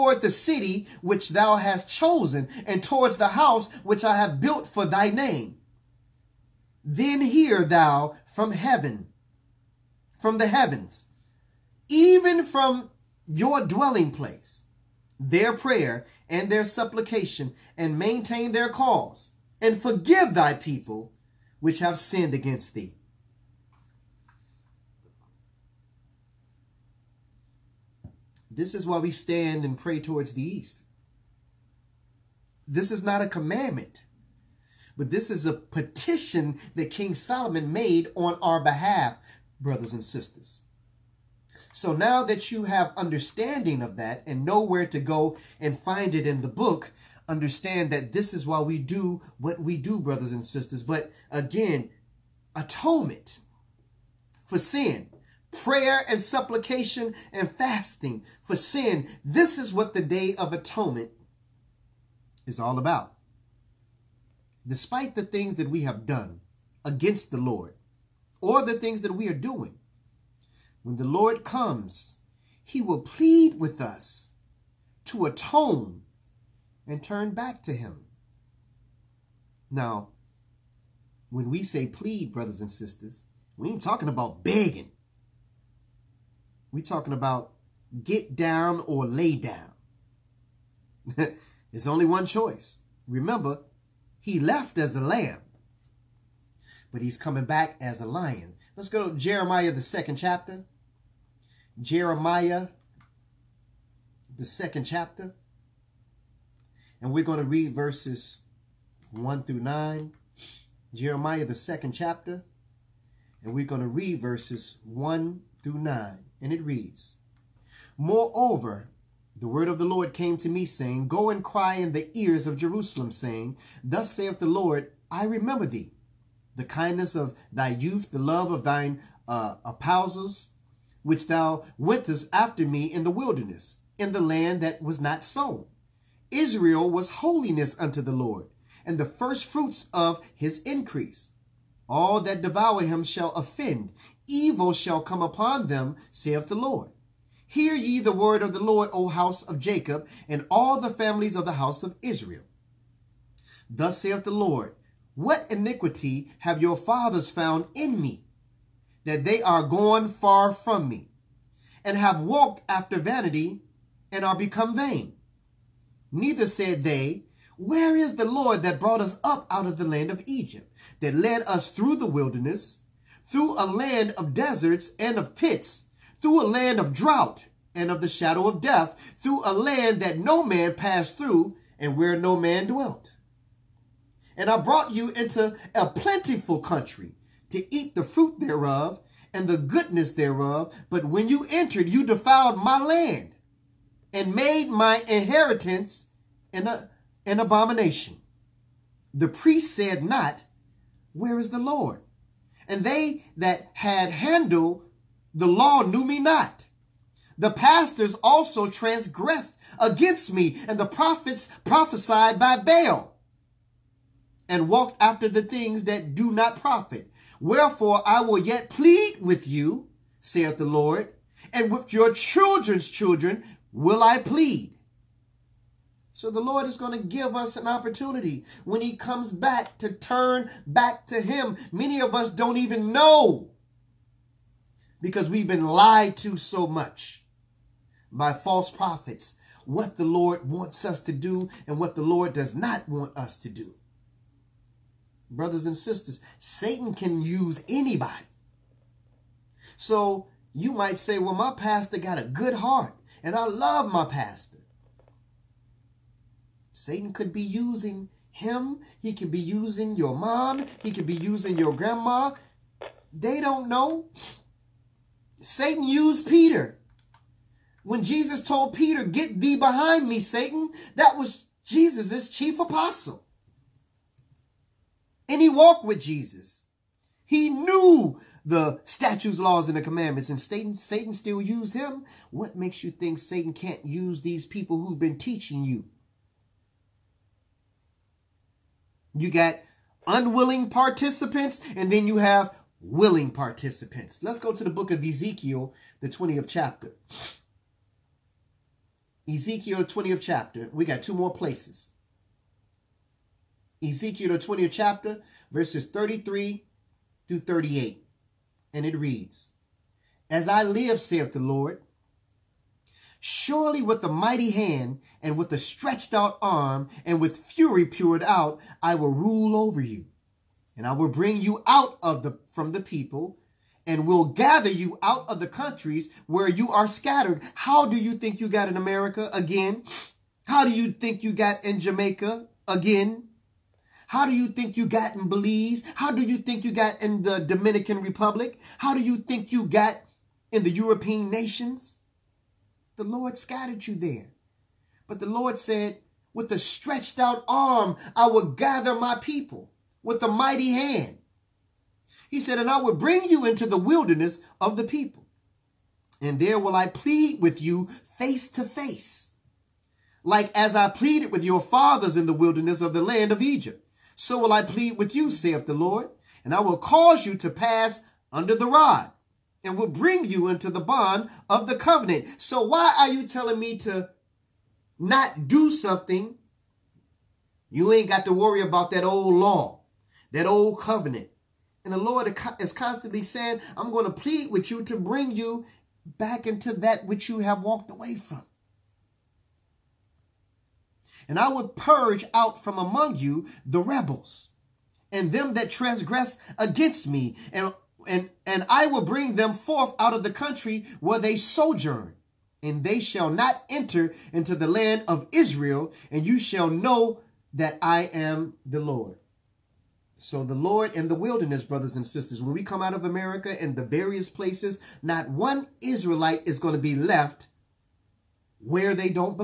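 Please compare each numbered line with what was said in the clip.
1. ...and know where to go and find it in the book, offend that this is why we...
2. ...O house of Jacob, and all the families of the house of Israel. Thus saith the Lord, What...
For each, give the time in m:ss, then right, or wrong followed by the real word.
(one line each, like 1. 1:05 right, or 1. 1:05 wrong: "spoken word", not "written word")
1. 0:44 wrong: "understand", not "offend"
2. 2:28 right.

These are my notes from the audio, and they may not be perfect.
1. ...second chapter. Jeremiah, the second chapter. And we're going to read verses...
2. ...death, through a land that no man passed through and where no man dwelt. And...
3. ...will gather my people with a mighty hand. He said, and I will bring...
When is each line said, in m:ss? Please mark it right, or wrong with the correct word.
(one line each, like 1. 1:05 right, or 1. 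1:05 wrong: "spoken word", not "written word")
1. 1:39 right
2. 2:58 right
3. 5:48 right.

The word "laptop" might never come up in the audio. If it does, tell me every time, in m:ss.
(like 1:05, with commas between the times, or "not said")
not said.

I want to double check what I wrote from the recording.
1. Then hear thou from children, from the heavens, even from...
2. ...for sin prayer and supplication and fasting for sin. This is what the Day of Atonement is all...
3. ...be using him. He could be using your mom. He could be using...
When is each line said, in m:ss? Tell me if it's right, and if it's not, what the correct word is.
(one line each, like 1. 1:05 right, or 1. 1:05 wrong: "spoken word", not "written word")
1. 0:06 wrong: "heaven", not "children"
2. 0:54 right
3. 4:17 right.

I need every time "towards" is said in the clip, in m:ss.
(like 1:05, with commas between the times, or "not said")
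0:02, 0:29.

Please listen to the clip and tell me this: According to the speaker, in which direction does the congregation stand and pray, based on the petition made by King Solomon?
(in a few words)
East.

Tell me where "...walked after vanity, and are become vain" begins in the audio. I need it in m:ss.
2:42.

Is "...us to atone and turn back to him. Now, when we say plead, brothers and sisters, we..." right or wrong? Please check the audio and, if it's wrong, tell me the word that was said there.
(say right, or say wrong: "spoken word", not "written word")
right.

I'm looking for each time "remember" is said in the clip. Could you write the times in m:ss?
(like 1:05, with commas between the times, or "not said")
1:33, 2:05.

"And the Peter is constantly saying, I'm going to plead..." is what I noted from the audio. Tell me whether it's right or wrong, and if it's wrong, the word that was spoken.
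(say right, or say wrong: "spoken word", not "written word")
wrong: "Lord", not "Peter".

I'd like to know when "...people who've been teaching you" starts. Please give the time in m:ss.
4:44.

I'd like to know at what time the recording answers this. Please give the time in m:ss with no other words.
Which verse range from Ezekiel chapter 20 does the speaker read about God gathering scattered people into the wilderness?
5:05.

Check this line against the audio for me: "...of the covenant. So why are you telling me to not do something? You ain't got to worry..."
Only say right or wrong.
right.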